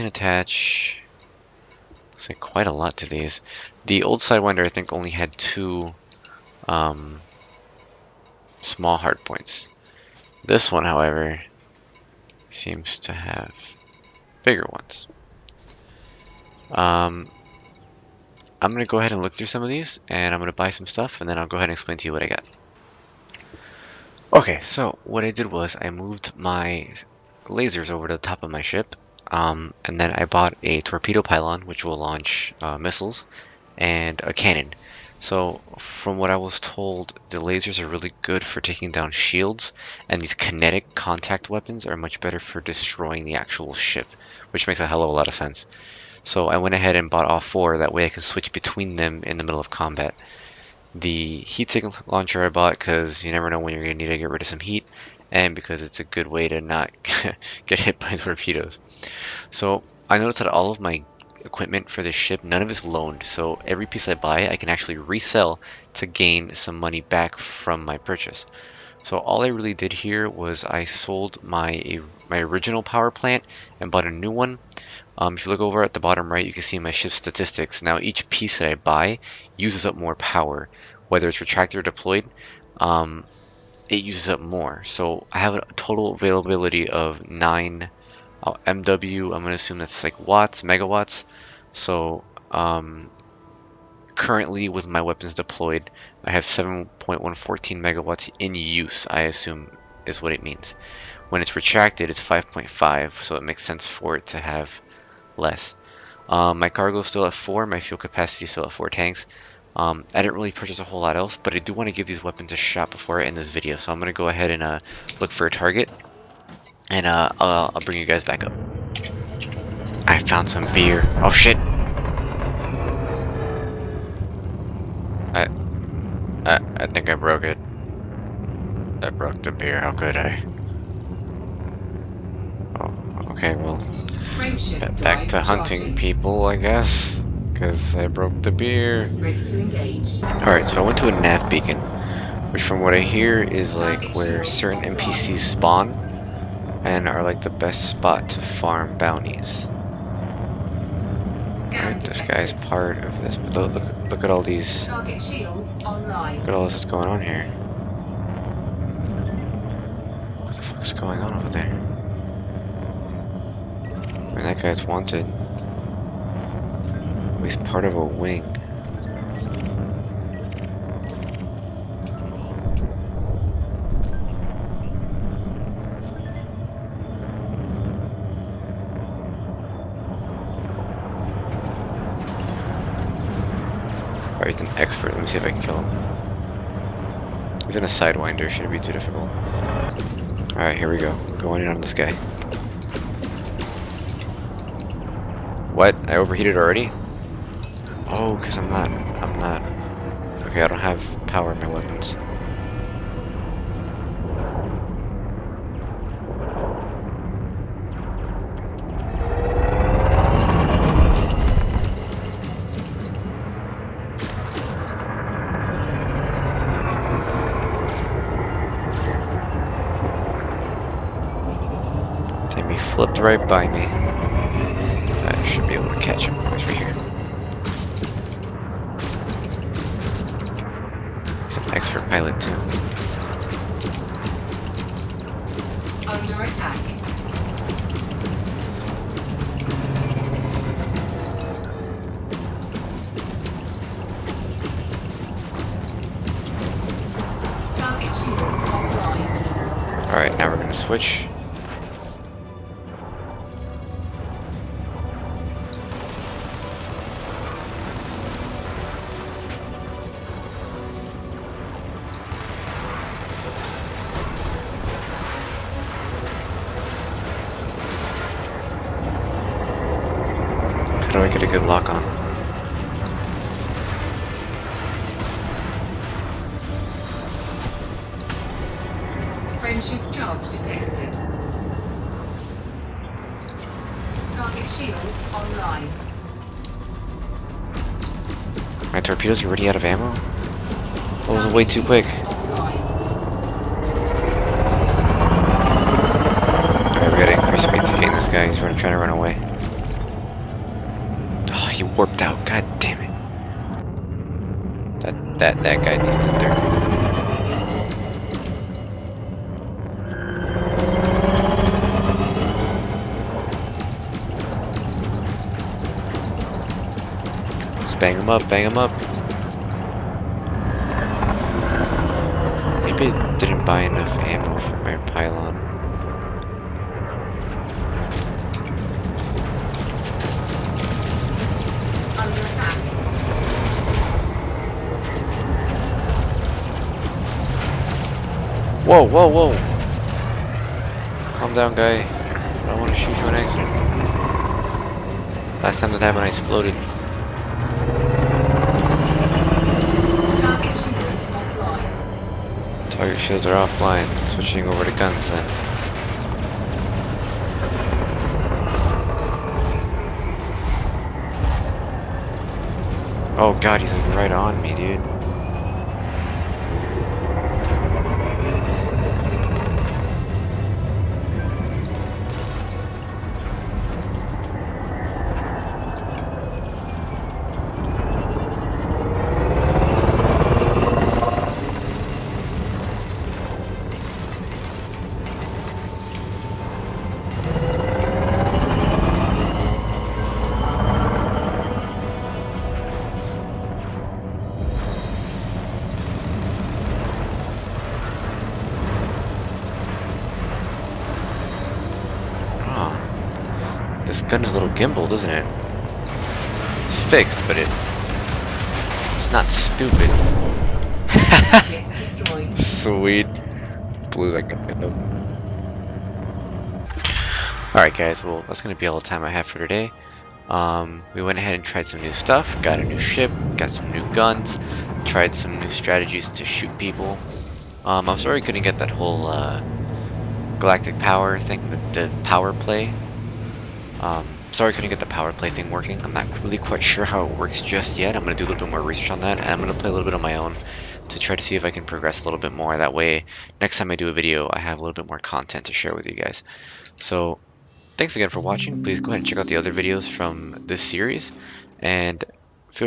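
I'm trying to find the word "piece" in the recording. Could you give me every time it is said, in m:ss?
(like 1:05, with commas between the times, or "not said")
1:03, 1:18.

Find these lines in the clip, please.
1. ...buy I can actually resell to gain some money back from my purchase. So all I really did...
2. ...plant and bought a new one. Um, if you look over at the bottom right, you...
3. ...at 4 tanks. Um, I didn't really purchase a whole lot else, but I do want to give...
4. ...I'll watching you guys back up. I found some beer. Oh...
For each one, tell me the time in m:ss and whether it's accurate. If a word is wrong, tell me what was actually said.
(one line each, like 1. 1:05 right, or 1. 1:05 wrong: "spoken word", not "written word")
1. 1:04 right
2. 1:13 right
3. 1:48 right
4. 1:57 wrong: "bring", not "watching".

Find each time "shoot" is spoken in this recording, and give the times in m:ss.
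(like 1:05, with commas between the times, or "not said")
5:42, 7:06.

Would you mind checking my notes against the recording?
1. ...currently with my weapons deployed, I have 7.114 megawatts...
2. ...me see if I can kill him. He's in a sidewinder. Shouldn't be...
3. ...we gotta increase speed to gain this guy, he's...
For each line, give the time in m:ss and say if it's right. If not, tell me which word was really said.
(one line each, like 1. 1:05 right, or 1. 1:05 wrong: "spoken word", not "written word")
1. 1:34 right
2. 3:05 right
3. 4:57 right.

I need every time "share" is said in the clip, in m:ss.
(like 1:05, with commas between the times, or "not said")
7:25.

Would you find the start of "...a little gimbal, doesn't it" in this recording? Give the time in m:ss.
6:44.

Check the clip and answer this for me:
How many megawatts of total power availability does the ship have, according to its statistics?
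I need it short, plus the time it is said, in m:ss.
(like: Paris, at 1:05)
9, at 1:27.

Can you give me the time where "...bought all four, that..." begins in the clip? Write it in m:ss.
0:47.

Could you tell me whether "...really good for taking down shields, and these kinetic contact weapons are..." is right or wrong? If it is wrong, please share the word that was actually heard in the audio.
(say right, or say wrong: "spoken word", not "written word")
right.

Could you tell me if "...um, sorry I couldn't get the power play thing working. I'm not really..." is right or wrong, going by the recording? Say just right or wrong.
right.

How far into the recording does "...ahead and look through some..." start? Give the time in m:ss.
0:18.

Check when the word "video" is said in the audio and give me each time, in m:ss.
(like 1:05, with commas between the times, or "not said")
1:53, 7:24, 7:29.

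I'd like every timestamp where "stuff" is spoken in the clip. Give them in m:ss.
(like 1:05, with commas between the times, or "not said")
0:20, 7:02.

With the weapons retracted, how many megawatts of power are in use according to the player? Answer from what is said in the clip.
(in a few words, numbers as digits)
5.5.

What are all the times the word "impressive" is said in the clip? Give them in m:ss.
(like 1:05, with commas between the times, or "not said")
not said.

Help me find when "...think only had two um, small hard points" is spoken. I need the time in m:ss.
0:04.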